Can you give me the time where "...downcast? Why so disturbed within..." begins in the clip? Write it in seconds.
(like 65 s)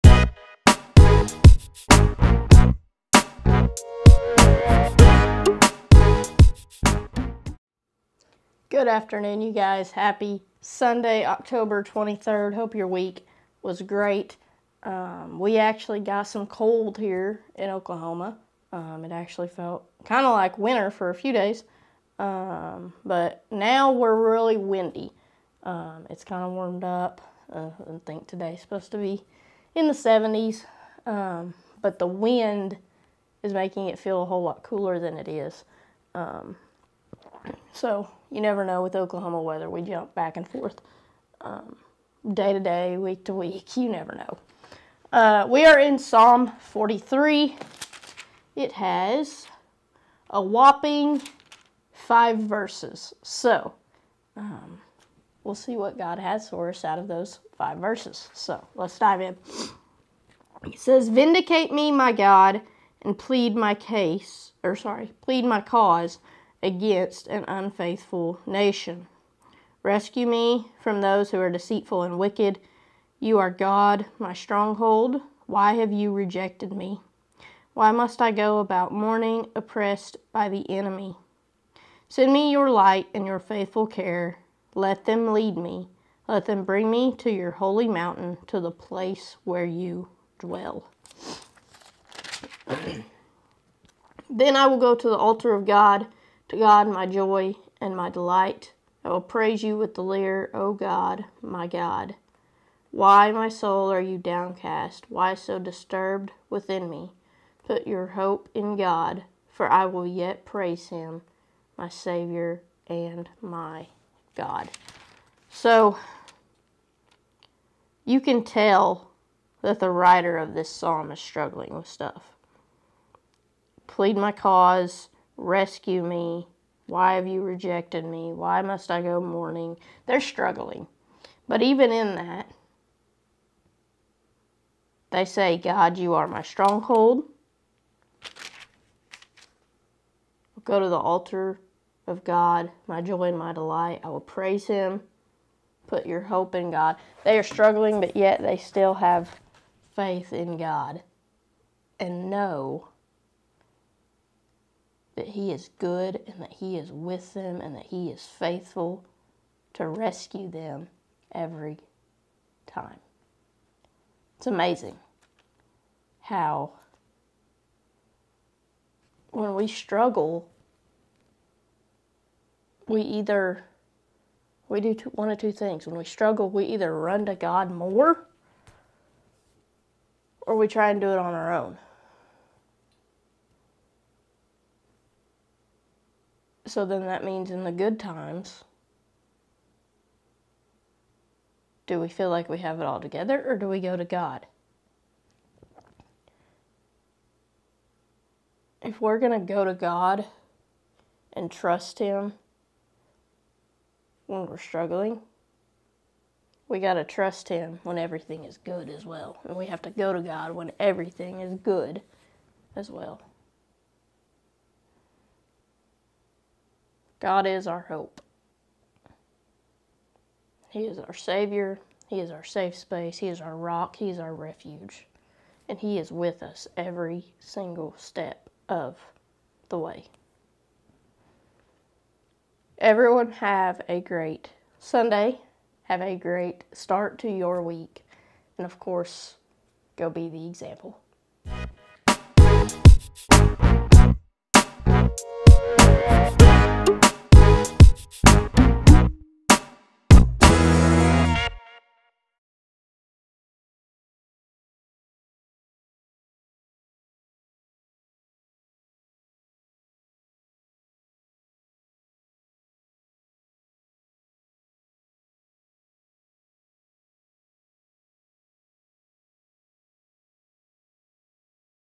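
104 s.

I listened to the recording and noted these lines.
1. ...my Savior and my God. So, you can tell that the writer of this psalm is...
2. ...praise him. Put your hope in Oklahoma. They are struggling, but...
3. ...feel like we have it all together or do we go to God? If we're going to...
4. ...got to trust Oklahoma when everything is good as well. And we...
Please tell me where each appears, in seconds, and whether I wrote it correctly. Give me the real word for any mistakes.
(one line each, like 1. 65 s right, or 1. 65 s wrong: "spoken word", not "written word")
1. 111 s right
2. 144 s wrong: "God", not "Oklahoma"
3. 192 s right
4. 206 s wrong: "Him", not "Oklahoma".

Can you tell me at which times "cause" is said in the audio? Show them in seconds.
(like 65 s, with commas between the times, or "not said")
65 s, 124 s.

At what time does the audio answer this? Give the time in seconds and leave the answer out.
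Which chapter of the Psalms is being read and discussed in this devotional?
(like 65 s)
45 s.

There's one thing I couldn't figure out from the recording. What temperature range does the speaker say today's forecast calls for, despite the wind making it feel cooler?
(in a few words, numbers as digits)
the 70s.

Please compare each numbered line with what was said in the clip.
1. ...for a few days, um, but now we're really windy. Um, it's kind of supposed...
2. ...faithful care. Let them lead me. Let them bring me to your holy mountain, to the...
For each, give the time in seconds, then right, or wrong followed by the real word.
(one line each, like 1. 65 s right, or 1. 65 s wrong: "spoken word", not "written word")
1. 20 s wrong: "warmed", not "supposed"
2. 83 s right.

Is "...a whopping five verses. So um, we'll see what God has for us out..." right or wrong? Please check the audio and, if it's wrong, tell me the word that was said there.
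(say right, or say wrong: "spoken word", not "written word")
right.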